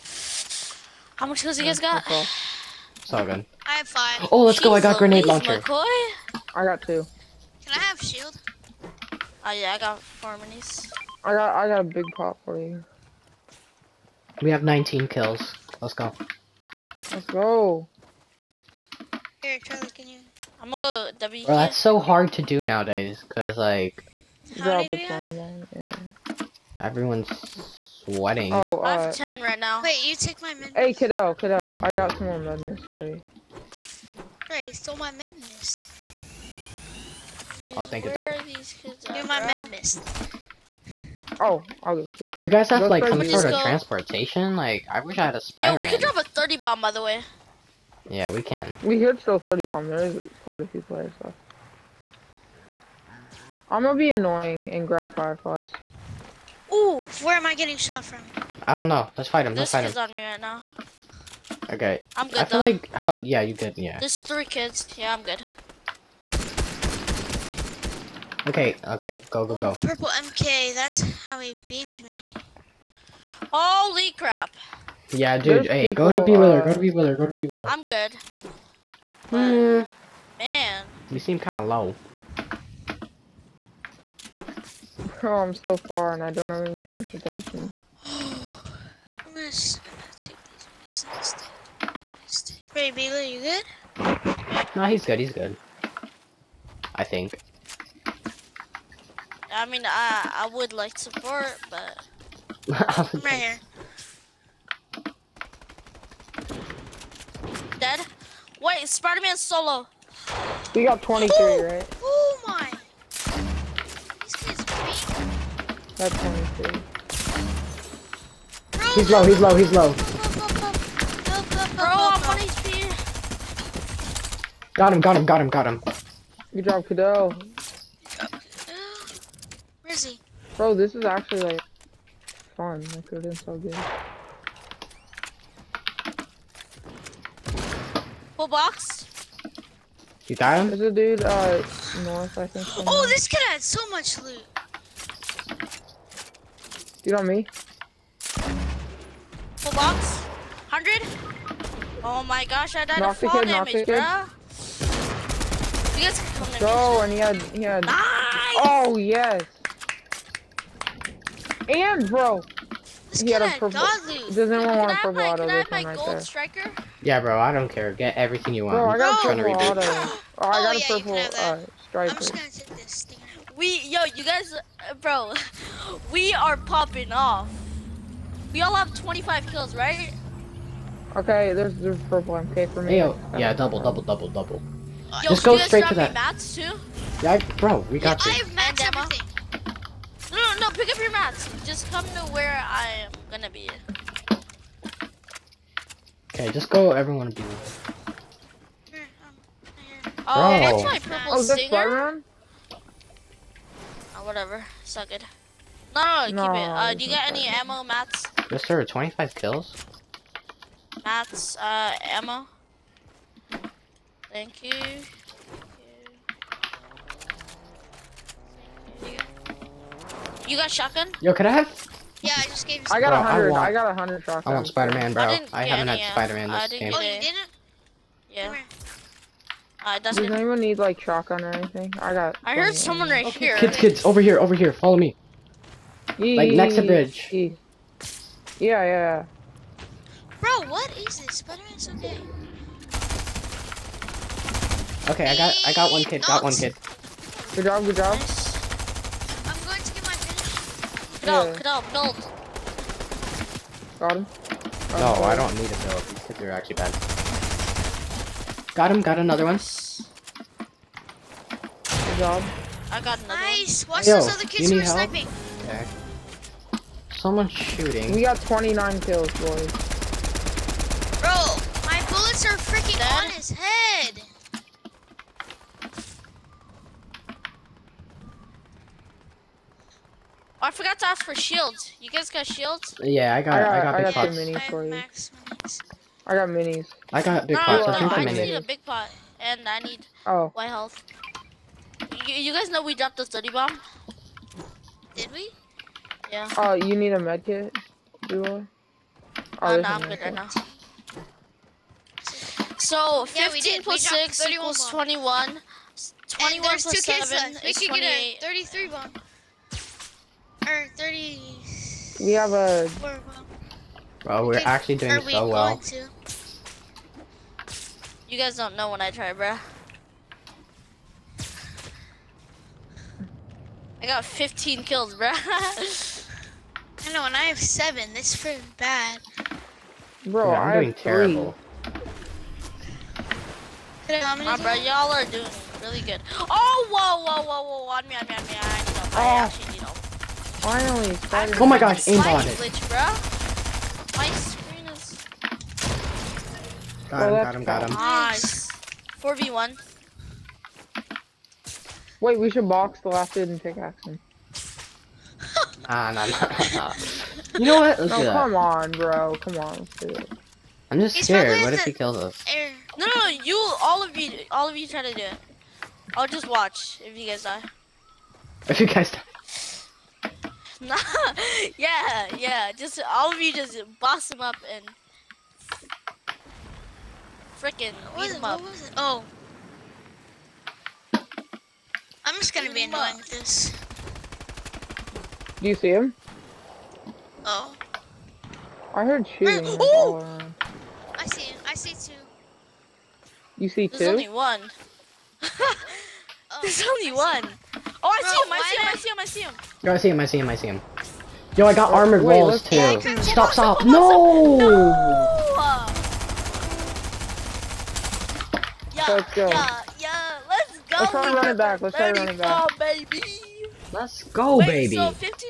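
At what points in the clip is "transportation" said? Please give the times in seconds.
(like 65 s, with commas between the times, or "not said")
43 s, 86 s.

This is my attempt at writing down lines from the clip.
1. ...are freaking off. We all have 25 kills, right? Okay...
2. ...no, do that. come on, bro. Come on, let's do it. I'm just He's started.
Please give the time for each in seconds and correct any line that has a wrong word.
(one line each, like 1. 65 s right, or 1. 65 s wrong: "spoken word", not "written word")
1. 176 s wrong: "popping", not "freaking"
2. 358 s wrong: "scared", not "started".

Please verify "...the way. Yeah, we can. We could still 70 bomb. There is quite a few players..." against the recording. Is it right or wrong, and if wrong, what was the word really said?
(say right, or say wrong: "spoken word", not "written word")
wrong: "30", not "70".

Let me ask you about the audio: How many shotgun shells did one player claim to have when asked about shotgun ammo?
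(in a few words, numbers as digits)
100.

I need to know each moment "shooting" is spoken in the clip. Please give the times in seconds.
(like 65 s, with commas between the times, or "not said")
267 s, 389 s.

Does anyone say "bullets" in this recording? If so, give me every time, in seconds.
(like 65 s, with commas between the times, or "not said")
272 s.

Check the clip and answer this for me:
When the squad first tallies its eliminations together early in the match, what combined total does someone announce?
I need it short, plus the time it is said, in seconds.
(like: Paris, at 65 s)
19, at 14 s.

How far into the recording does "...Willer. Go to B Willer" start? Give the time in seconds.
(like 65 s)
76 s.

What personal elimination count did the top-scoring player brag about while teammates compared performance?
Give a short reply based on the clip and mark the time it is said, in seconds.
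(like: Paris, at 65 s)
15, at 324 s.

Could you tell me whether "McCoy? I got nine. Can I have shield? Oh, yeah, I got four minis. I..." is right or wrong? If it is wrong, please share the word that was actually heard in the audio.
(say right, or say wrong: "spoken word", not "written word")
wrong: "two", not "nine".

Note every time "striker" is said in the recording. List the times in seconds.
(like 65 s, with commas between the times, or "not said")
166 s, 171 s.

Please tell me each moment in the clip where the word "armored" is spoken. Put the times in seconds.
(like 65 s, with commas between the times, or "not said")
401 s.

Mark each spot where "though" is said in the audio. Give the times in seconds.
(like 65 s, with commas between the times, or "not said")
62 s, 255 s.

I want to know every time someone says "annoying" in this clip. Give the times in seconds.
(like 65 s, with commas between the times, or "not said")
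54 s, 382 s.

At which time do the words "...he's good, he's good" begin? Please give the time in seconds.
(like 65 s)
94 s.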